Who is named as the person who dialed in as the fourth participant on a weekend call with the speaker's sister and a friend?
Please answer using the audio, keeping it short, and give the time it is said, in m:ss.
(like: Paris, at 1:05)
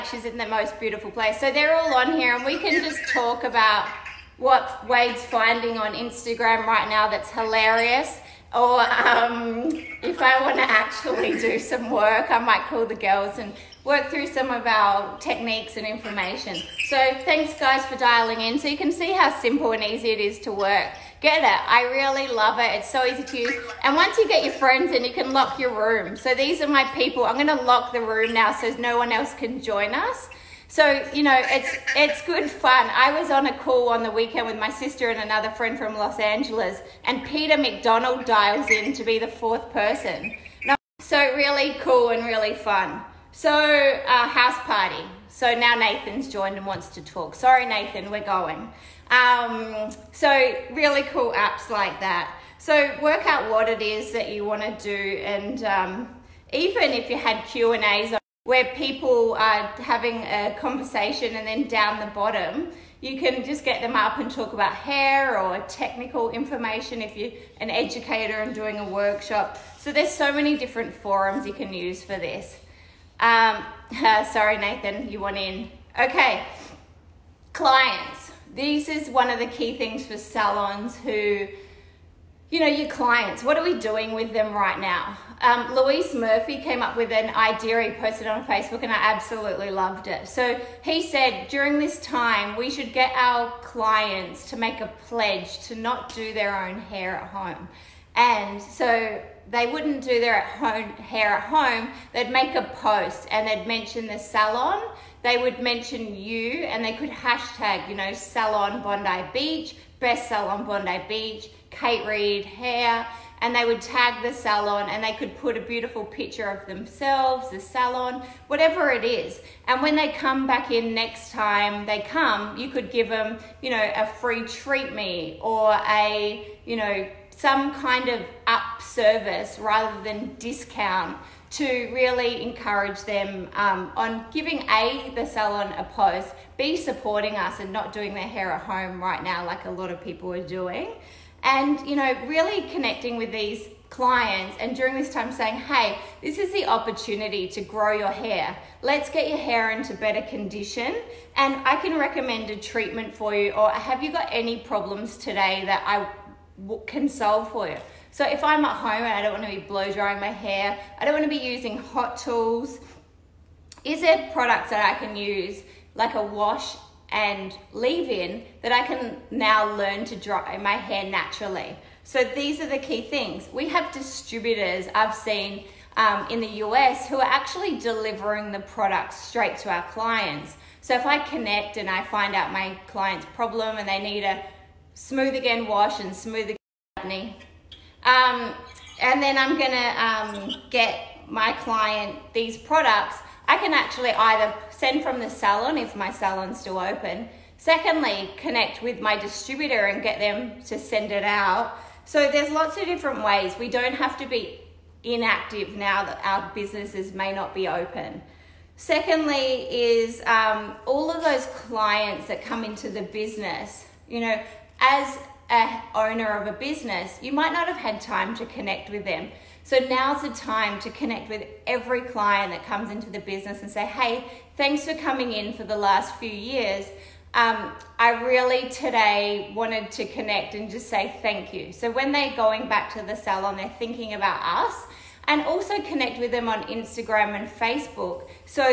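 Peter McDonald, at 0:37.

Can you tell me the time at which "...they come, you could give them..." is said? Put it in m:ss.
2:01.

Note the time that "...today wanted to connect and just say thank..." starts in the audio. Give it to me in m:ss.
3:48.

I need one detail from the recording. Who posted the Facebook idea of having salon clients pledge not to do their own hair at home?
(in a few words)
Louise Murphy.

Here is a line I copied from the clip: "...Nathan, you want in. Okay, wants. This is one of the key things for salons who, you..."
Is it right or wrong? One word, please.
wrong.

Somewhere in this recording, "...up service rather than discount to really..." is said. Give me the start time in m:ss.
2:08.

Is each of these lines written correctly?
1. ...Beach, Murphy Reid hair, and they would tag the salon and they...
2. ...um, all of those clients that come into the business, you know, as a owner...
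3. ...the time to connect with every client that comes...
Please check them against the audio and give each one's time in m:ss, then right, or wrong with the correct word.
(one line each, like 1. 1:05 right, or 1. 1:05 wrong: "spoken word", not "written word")
1. 1:51 wrong: "Kate", not "Murphy"
2. 3:30 right
3. 3:40 right.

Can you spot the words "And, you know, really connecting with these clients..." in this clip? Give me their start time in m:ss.
2:21.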